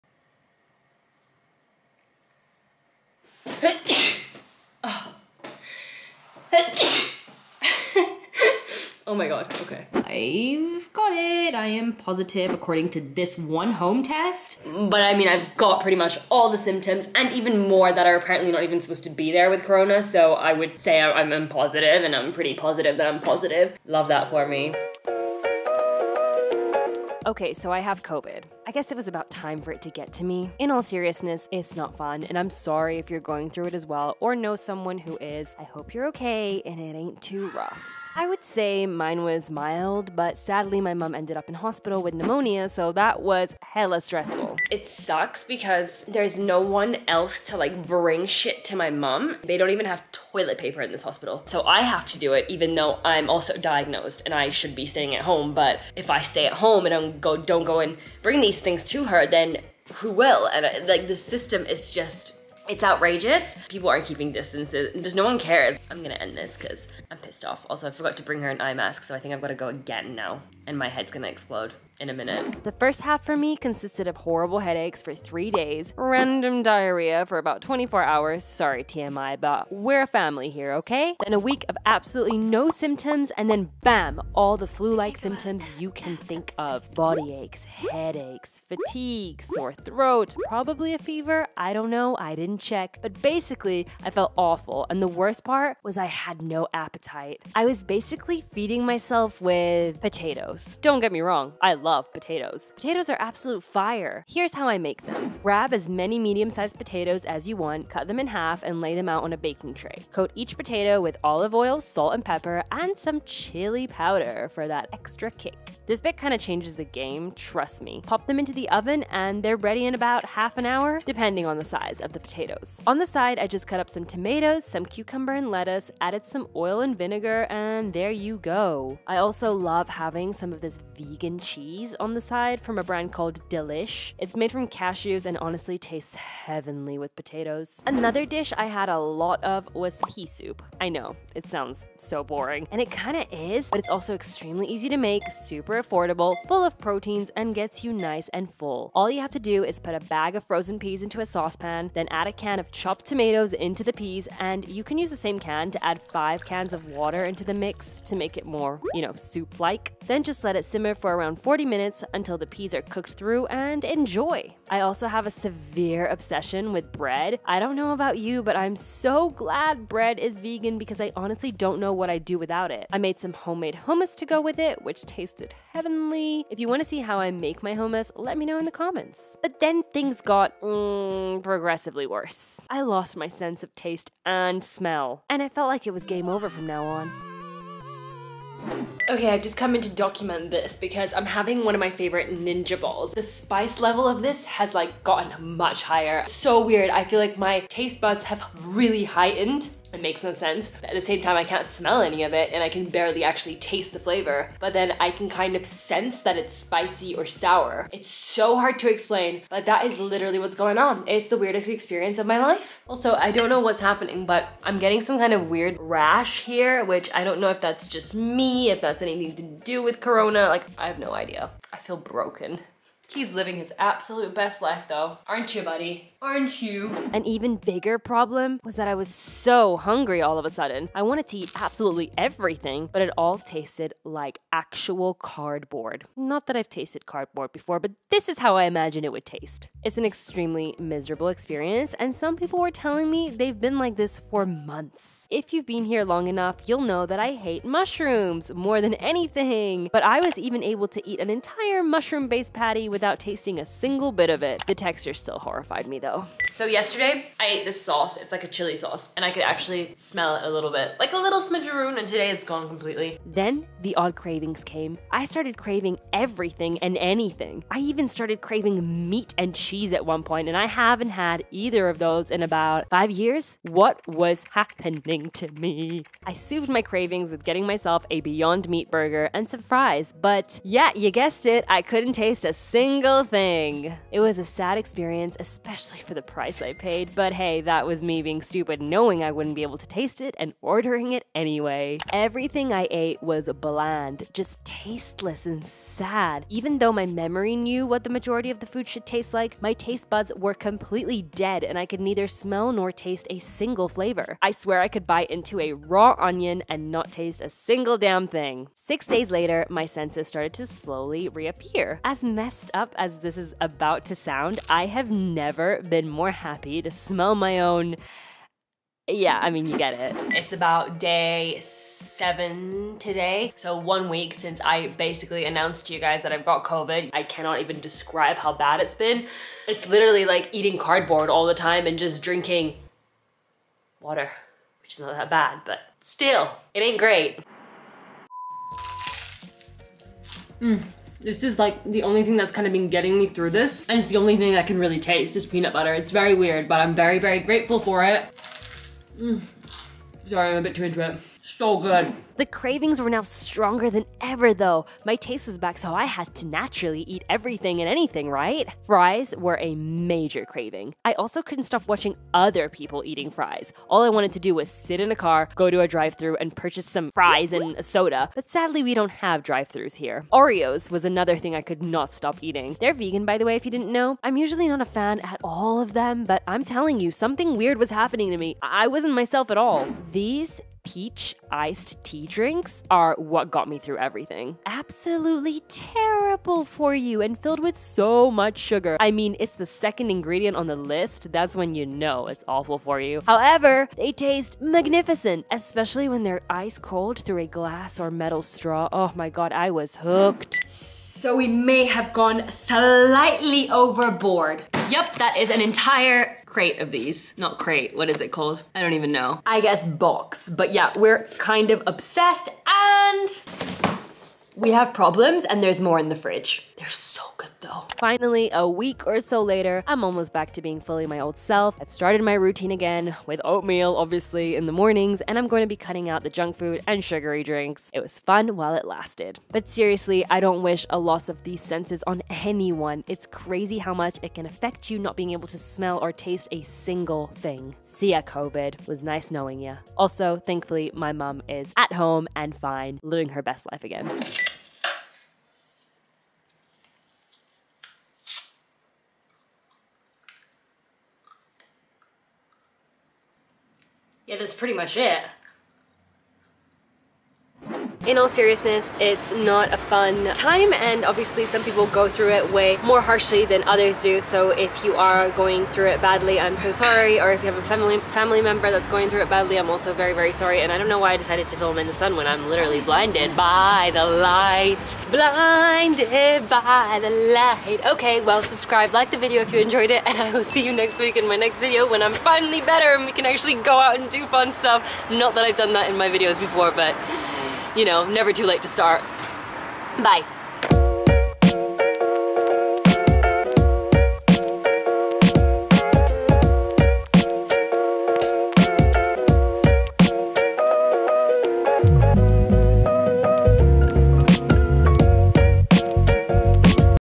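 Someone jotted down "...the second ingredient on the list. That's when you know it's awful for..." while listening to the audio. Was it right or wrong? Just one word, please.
right.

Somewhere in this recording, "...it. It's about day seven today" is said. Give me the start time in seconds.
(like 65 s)
319 s.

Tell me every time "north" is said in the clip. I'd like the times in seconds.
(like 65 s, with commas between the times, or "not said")
not said.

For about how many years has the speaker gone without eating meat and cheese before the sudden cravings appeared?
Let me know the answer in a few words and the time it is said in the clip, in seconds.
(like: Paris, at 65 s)
5, at 272 s.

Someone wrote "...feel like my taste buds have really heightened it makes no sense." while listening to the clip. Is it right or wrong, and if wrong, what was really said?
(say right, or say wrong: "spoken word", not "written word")
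right.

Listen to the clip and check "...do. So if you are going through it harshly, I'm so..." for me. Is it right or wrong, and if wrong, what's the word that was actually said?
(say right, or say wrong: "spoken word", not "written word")
wrong: "badly", not "harshly".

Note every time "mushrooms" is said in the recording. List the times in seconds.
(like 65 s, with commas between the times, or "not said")
247 s, 251 s.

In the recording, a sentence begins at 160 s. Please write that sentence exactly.
Then just let it simmer for around 40 40 minutes until the peas are cooked through and enjoy.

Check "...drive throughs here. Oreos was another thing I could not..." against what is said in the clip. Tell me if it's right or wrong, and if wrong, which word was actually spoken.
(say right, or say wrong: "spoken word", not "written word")
right.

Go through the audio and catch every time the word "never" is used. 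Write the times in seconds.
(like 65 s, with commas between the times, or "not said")
315 s, 488 s.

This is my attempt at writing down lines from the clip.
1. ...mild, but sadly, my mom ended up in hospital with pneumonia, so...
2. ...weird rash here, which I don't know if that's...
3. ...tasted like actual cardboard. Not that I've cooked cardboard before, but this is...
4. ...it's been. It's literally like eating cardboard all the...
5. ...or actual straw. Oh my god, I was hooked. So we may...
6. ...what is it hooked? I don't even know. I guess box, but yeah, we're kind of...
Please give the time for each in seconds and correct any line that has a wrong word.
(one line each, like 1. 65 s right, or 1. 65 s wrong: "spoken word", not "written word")
1. 39 s right
2. 215 s right
3. 233 s wrong: "tasted", not "cooked"
4. 328 s right
5. 397 s wrong: "metal", not "actual"
6. 407 s wrong: "called", not "hooked".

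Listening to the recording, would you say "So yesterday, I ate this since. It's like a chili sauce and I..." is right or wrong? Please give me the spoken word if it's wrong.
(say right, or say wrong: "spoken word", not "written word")
wrong: "sauce", not "since".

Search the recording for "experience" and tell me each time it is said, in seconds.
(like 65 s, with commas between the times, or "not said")
211 s, 241 s, 284 s.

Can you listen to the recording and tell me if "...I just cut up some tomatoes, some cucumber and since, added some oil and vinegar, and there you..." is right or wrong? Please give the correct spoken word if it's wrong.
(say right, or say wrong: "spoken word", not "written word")
wrong: "lettuce", not "since".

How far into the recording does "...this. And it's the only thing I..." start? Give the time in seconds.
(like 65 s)
343 s.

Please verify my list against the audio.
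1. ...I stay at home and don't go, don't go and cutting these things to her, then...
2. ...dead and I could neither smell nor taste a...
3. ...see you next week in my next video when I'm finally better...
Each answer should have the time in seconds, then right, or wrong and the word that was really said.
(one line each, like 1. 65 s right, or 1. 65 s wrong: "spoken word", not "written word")
1. 56 s wrong: "bring", not "cutting"
2. 301 s right
3. 480 s right.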